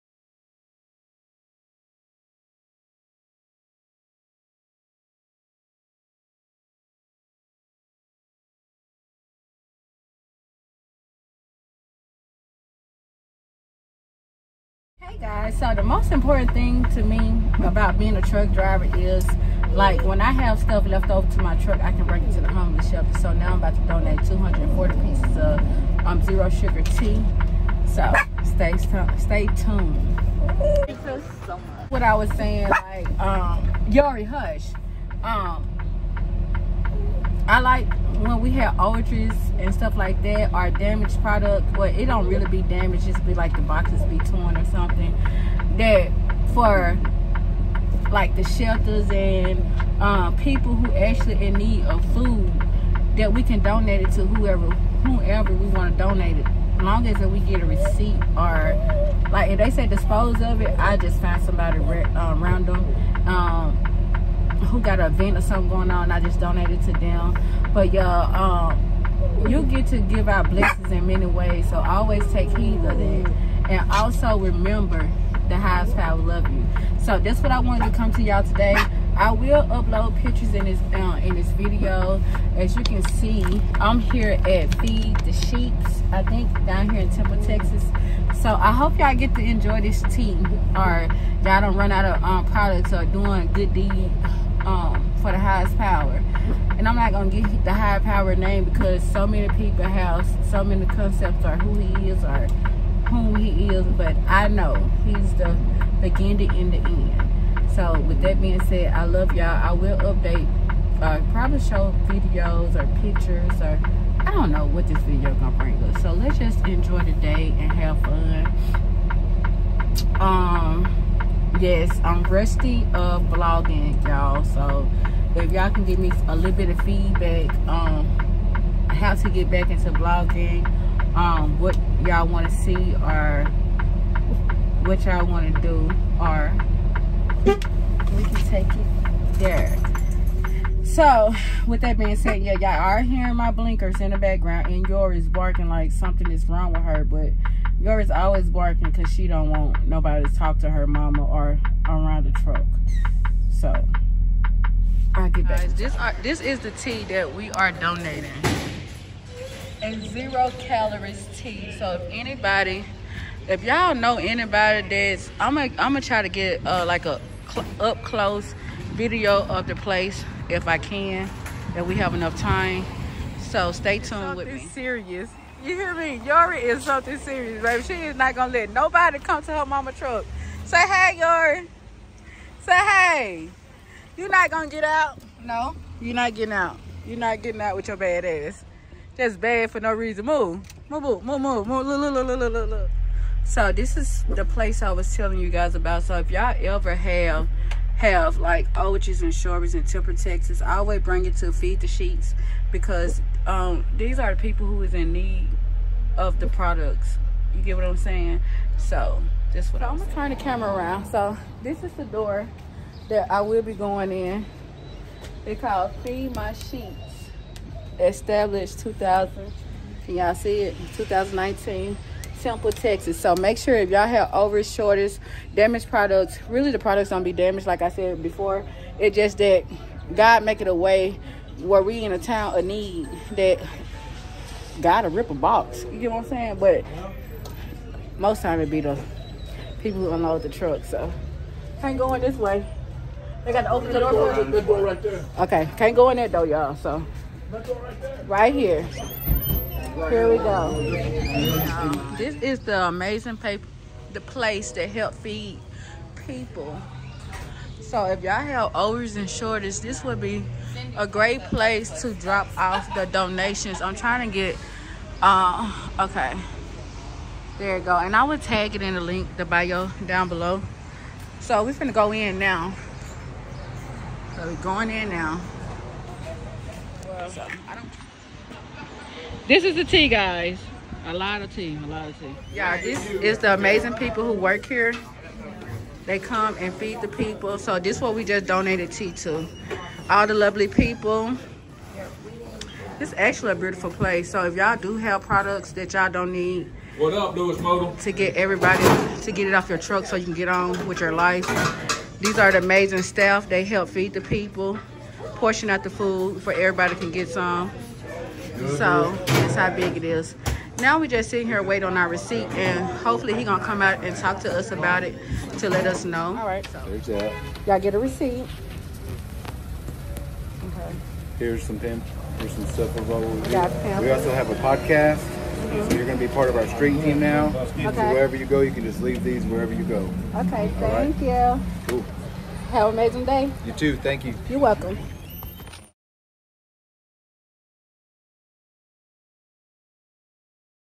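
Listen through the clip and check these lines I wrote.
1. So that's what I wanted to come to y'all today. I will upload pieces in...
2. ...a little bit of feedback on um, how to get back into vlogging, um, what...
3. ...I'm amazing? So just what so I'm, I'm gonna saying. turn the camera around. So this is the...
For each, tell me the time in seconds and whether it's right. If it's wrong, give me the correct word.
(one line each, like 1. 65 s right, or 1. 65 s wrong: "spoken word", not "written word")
1. 77 s wrong: "pictures", not "pieces"
2. 126 s right
3. 207 s wrong: "saying", not "amazing".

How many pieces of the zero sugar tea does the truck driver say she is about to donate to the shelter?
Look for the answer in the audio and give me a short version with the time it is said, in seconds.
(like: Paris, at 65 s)
240, at 24 s.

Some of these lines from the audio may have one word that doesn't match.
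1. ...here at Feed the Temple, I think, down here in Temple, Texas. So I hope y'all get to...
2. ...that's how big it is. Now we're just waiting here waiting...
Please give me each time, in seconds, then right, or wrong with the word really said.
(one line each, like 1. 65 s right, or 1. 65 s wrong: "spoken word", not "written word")
1. 83 s wrong: "Sheeps", not "Temple"
2. 309 s wrong: "sitting", not "waiting".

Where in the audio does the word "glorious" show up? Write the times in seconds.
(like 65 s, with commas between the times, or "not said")
not said.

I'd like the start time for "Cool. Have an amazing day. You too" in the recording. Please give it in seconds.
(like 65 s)
331 s.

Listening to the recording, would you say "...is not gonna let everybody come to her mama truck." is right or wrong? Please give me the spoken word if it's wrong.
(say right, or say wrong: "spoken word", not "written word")
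wrong: "nobody", not "everybody".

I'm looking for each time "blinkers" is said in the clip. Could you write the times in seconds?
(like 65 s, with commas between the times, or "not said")
143 s.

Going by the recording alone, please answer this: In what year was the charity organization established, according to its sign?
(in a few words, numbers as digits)
2019.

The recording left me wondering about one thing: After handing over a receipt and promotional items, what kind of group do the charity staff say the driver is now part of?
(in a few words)
street team.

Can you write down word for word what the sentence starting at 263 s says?
I'm trying to get, uh, okay.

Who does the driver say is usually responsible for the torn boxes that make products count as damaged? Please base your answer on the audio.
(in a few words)
the people who unload the truck.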